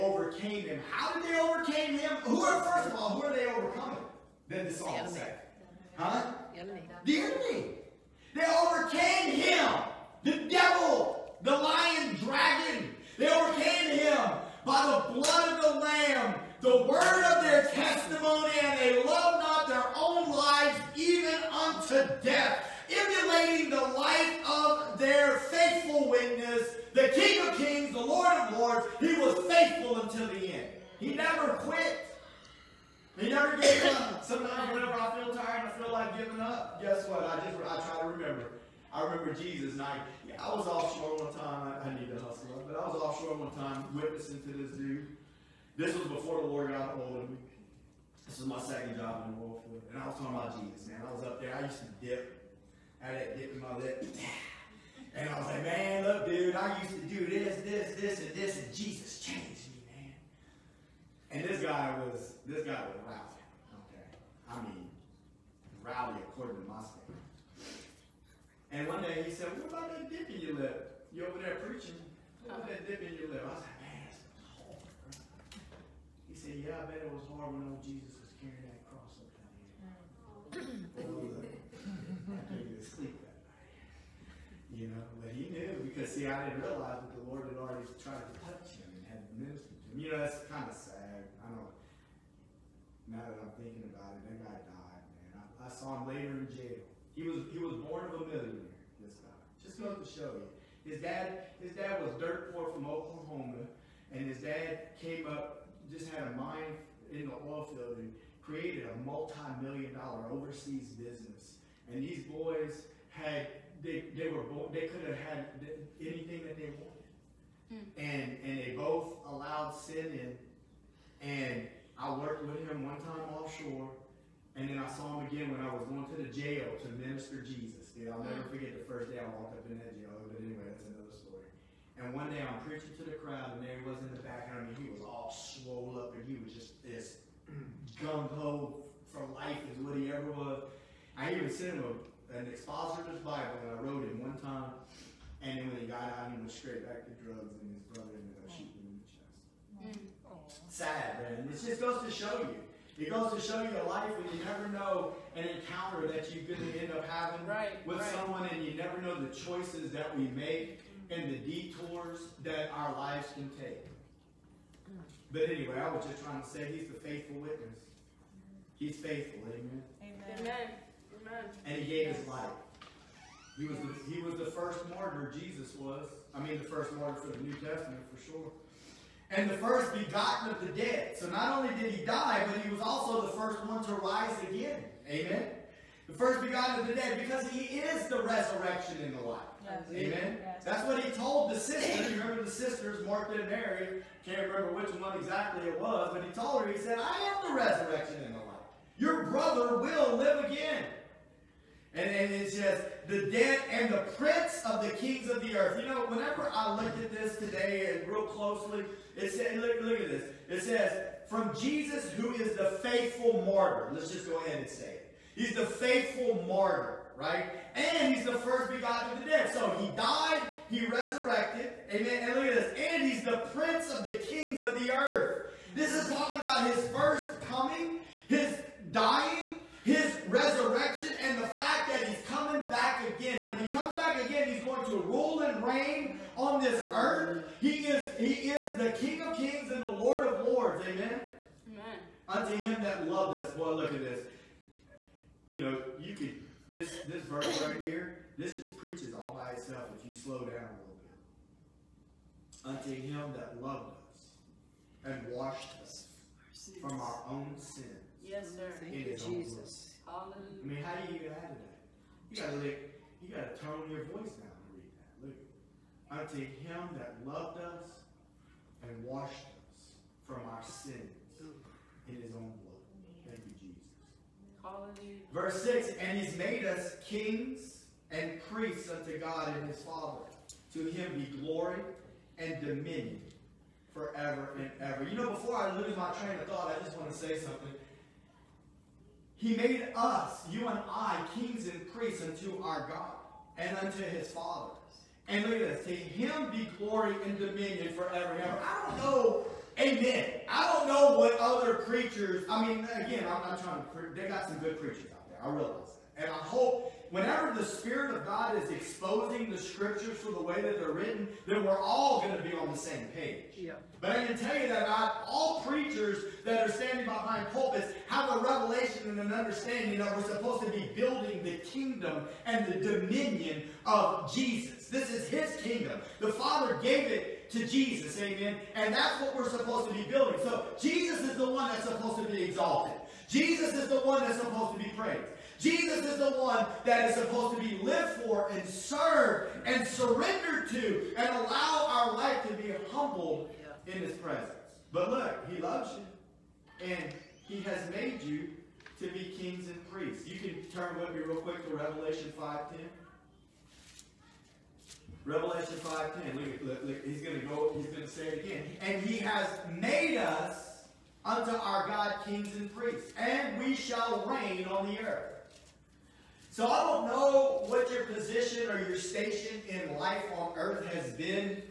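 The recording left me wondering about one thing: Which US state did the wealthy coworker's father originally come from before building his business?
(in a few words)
Oklahoma.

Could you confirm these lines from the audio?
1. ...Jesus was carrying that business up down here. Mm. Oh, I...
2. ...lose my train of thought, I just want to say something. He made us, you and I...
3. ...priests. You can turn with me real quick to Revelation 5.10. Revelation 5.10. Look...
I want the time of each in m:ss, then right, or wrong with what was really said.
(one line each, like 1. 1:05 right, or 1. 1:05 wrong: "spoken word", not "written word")
1. 1:17 wrong: "cross", not "business"
2. 4:45 right
3. 5:49 right.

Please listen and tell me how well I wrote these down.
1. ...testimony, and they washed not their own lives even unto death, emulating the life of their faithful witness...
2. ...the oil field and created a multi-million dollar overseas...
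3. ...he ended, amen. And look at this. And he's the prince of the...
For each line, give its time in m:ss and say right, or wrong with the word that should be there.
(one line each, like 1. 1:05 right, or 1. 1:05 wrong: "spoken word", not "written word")
1. 0:17 wrong: "loved", not "washed"
2. 1:47 right
3. 3:40 wrong: "resurrected", not "ended".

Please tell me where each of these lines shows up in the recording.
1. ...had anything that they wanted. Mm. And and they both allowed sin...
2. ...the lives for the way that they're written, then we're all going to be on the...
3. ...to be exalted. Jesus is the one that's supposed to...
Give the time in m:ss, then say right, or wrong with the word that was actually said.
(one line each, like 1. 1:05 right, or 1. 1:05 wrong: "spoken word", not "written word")
1. 1:55 right
2. 5:09 wrong: "scriptures", not "lives"
3. 5:32 right.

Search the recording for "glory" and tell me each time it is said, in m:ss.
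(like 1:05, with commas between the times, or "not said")
4:41, 4:56.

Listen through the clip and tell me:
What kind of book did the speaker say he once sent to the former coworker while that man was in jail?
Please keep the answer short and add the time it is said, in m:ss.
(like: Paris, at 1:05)
Expositor's Bible, at 2:22.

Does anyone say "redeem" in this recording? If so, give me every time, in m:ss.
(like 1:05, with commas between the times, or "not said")
not said.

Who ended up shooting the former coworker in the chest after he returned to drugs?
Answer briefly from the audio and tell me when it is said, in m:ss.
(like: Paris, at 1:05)
His brother, at 2:27.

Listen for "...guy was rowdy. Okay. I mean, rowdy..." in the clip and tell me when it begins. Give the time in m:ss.
1:02.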